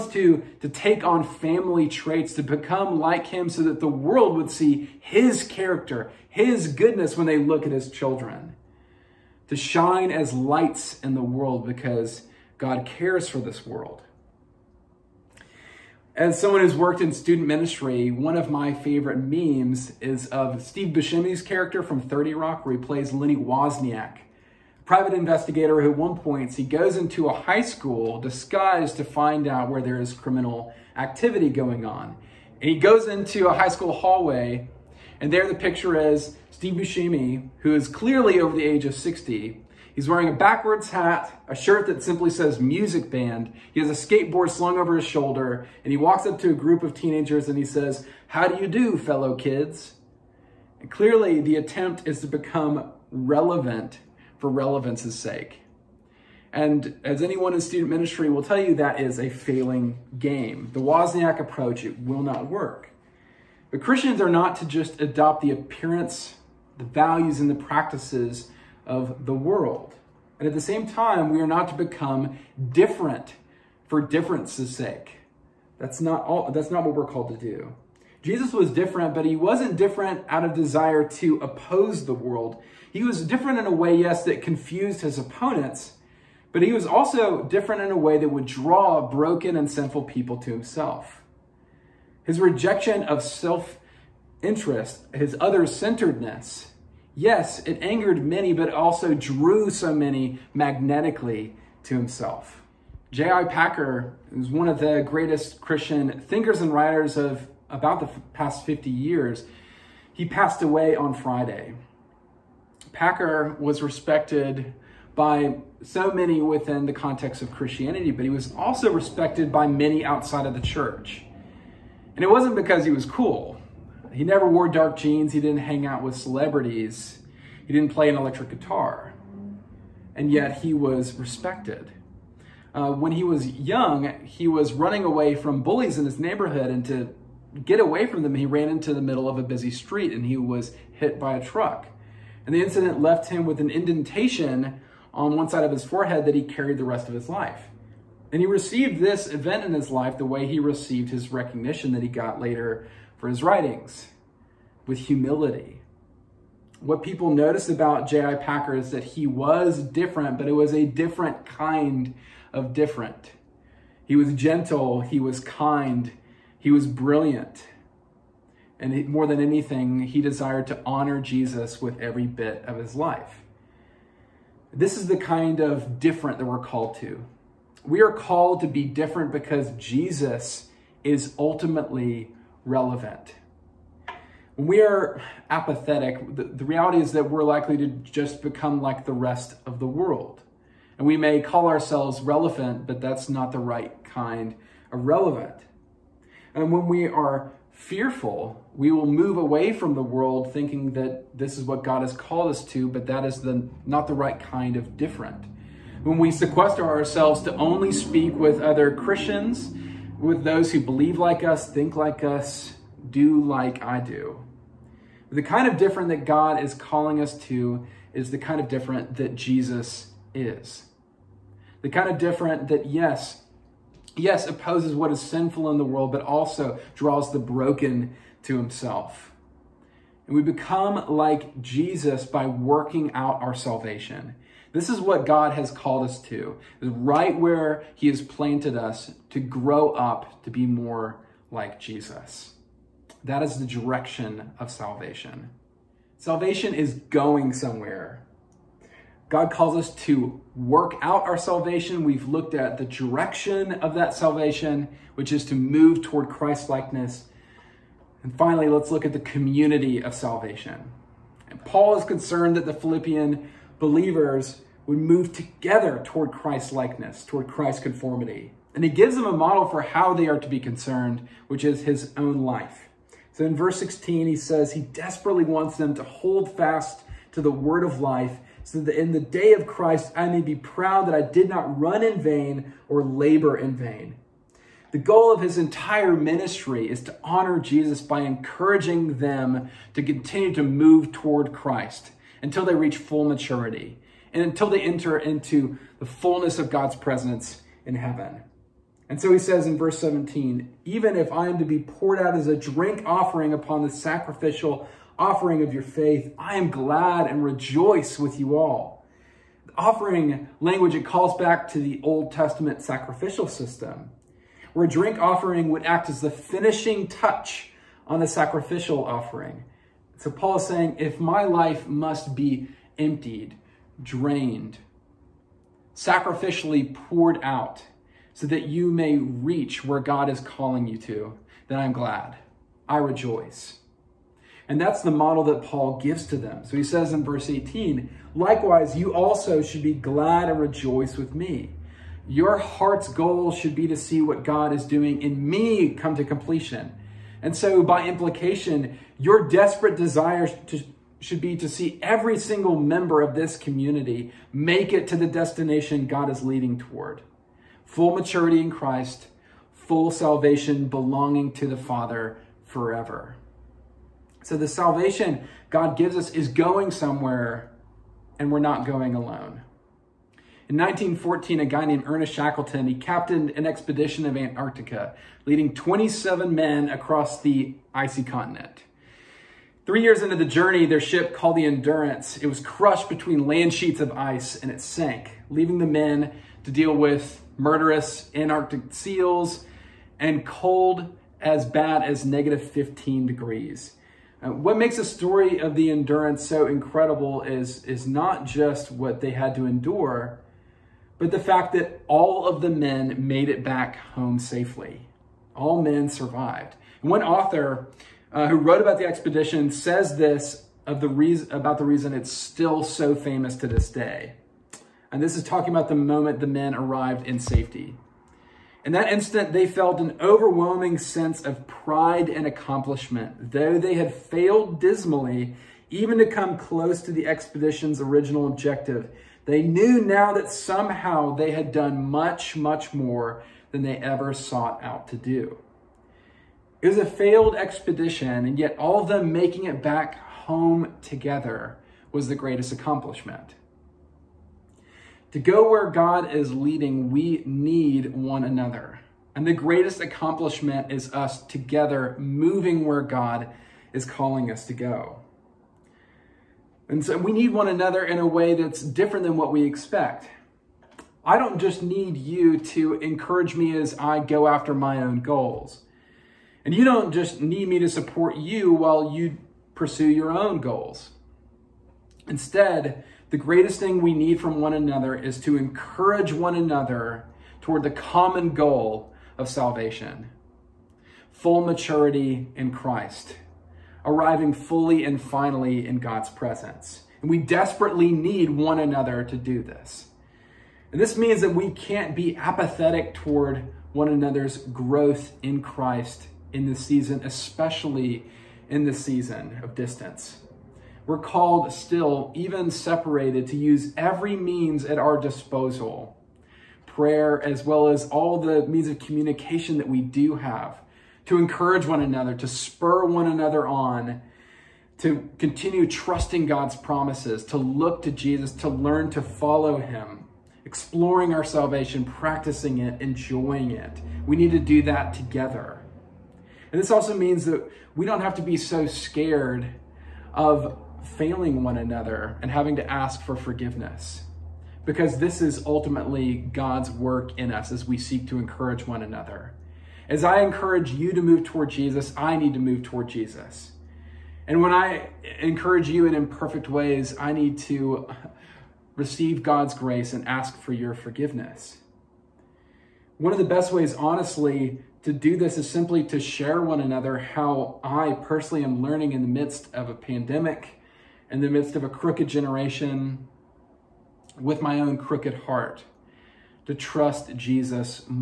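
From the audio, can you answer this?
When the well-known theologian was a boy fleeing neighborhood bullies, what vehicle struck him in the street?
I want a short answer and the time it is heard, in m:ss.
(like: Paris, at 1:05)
a truck, at 2:21.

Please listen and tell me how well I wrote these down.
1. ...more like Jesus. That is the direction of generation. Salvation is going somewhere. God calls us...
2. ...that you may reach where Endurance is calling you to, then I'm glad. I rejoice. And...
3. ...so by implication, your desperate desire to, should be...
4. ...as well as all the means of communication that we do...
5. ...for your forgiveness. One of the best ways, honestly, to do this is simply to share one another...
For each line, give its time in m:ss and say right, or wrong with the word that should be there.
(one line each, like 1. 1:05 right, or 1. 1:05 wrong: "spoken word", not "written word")
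1. 4:00 wrong: "salvation", not "generation"
2. 5:28 wrong: "God", not "Endurance"
3. 5:47 right
4. 8:27 right
5. 9:10 right.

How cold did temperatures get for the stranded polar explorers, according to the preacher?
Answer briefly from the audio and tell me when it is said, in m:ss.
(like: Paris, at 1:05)
-15 degrees, at 6:32.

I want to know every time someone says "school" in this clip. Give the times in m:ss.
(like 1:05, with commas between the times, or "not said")
0:27, 0:33.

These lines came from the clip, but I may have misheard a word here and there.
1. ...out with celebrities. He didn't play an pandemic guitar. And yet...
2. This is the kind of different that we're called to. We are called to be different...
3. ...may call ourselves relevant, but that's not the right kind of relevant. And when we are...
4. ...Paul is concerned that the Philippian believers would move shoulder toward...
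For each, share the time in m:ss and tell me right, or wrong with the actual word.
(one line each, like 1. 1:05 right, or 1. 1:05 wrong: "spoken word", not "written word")
1. 2:05 wrong: "electric", not "pandemic"
2. 2:54 right
3. 3:11 right
4. 4:21 wrong: "together", not "shoulder".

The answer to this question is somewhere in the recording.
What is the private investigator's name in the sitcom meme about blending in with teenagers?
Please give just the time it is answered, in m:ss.
0:23.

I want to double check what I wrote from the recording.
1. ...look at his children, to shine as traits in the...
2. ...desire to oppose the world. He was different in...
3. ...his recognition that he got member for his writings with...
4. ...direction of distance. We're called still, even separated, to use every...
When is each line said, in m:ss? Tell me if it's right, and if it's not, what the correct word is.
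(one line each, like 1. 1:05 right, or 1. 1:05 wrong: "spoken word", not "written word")
1. 0:07 wrong: "lights", not "traits"
2. 1:20 right
3. 2:31 wrong: "later", not "member"
4. 8:19 wrong: "season", not "direction".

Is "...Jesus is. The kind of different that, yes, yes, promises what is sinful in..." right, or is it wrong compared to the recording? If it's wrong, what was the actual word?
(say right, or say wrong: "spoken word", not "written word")
wrong: "opposes", not "promises".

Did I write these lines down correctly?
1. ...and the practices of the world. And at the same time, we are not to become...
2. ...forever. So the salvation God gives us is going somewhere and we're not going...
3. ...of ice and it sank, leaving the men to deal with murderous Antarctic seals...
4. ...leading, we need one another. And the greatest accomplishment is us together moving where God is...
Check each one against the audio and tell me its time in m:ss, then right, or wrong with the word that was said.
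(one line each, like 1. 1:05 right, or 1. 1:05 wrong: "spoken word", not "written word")
1. 1:07 right
2. 6:02 right
3. 6:23 right
4. 7:26 right.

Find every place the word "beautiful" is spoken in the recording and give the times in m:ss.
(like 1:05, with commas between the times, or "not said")
not said.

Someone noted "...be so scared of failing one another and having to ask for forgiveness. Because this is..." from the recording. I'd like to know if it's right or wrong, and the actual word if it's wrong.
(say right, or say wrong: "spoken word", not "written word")
right.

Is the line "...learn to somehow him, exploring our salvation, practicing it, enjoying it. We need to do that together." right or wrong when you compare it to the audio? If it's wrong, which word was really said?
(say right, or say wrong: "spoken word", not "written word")
wrong: "follow", not "somehow".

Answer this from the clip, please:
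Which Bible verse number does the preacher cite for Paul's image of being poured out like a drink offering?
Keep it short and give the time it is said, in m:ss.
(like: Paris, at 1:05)
17, at 4:59.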